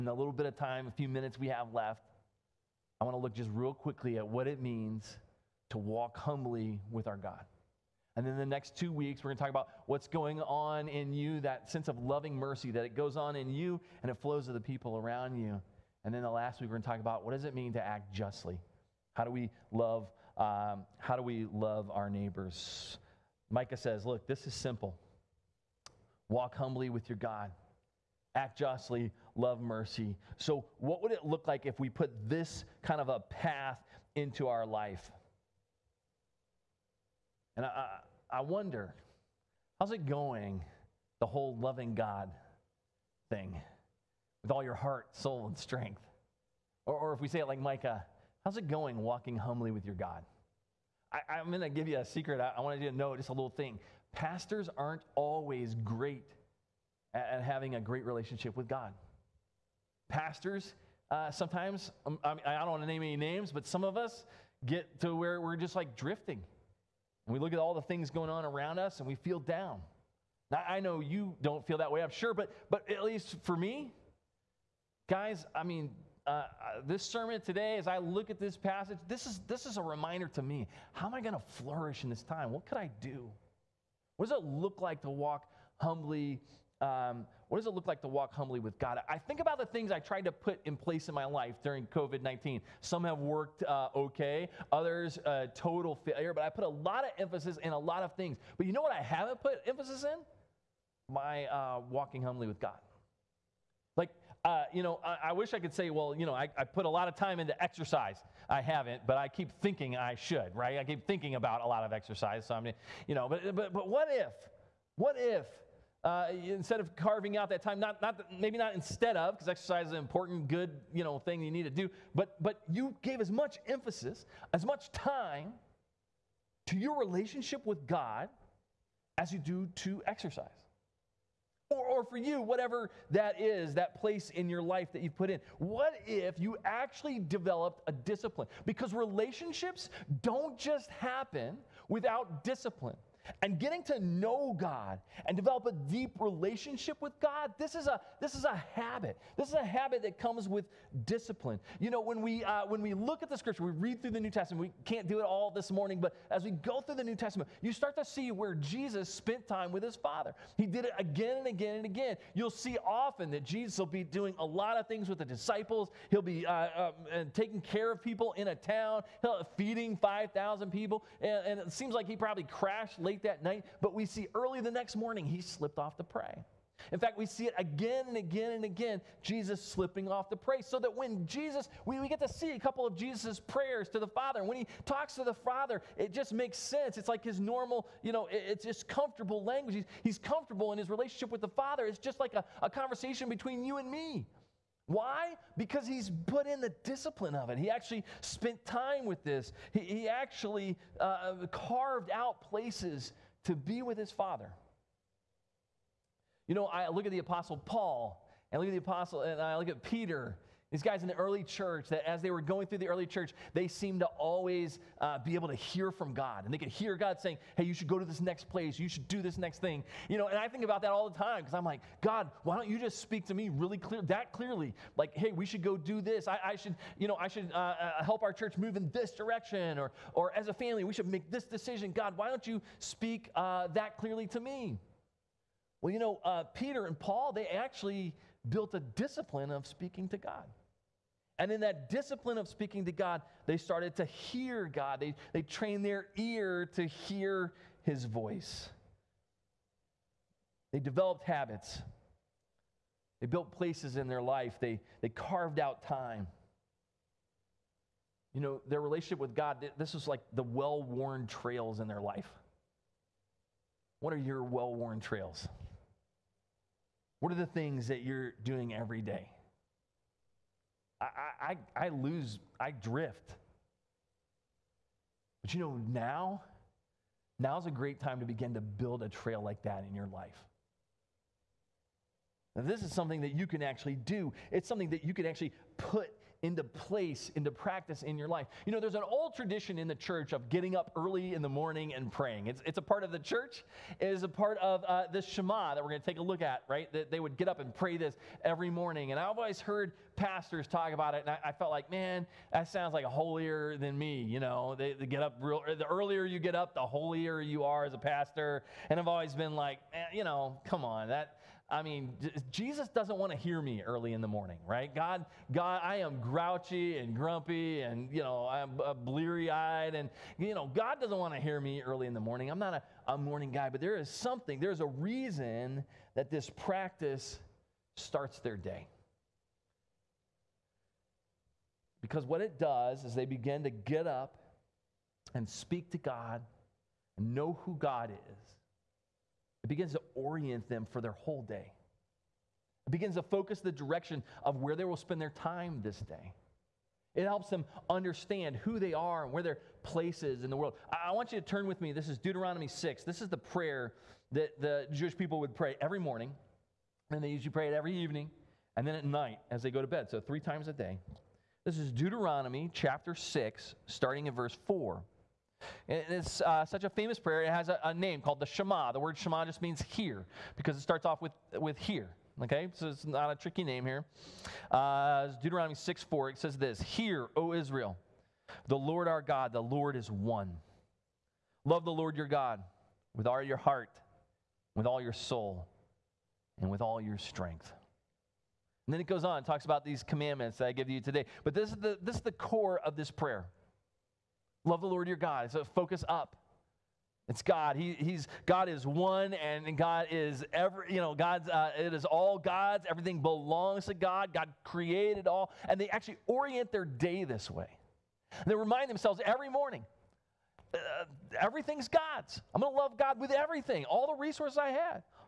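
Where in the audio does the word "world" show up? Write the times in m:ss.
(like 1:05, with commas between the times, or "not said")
5:50.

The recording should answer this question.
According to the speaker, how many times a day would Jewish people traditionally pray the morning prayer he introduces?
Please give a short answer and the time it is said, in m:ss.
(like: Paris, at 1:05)
3, at 6:00.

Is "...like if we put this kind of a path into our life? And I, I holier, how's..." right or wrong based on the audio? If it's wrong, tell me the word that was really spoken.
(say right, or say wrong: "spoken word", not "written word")
wrong: "wonder", not "holier".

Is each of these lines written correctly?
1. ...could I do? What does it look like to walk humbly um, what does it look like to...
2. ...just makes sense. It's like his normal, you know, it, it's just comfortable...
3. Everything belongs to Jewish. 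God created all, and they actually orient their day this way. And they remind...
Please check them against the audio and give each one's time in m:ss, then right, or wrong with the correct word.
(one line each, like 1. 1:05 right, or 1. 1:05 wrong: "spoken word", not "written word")
1. 1:22 right
2. 3:06 right
3. 6:42 wrong: "God", not "Jewish".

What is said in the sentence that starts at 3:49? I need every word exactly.
Or, or as a family, we should make this decision.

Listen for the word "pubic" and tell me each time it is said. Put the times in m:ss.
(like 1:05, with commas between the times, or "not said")
not said.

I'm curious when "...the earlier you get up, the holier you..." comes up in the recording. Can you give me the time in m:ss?
5:05.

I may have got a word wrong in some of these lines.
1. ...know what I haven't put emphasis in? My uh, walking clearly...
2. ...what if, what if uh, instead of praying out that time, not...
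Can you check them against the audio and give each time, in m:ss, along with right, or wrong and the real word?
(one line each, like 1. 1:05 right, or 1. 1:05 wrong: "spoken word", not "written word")
1. 1:38 wrong: "humbly", not "clearly"
2. 1:53 wrong: "carving", not "praying".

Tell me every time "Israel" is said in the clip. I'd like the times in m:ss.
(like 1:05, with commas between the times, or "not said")
6:17.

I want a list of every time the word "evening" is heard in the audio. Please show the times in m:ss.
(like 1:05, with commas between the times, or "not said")
5:57.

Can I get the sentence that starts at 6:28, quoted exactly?
And then it goes on, talks about these commandments that I give you today.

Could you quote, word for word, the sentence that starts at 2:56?
In fact, we see it again and again and again, Jesus slipping off to pray.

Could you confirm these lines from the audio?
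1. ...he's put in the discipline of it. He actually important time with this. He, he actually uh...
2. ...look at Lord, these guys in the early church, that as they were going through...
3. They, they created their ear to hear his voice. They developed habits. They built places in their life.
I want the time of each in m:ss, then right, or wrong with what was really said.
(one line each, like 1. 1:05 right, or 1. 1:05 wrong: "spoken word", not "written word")
1. 3:15 wrong: "spent", not "important"
2. 3:29 wrong: "Peter", not "Lord"
3. 4:04 wrong: "trained", not "created".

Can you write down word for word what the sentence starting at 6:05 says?
And it's uh, such a famous prayer.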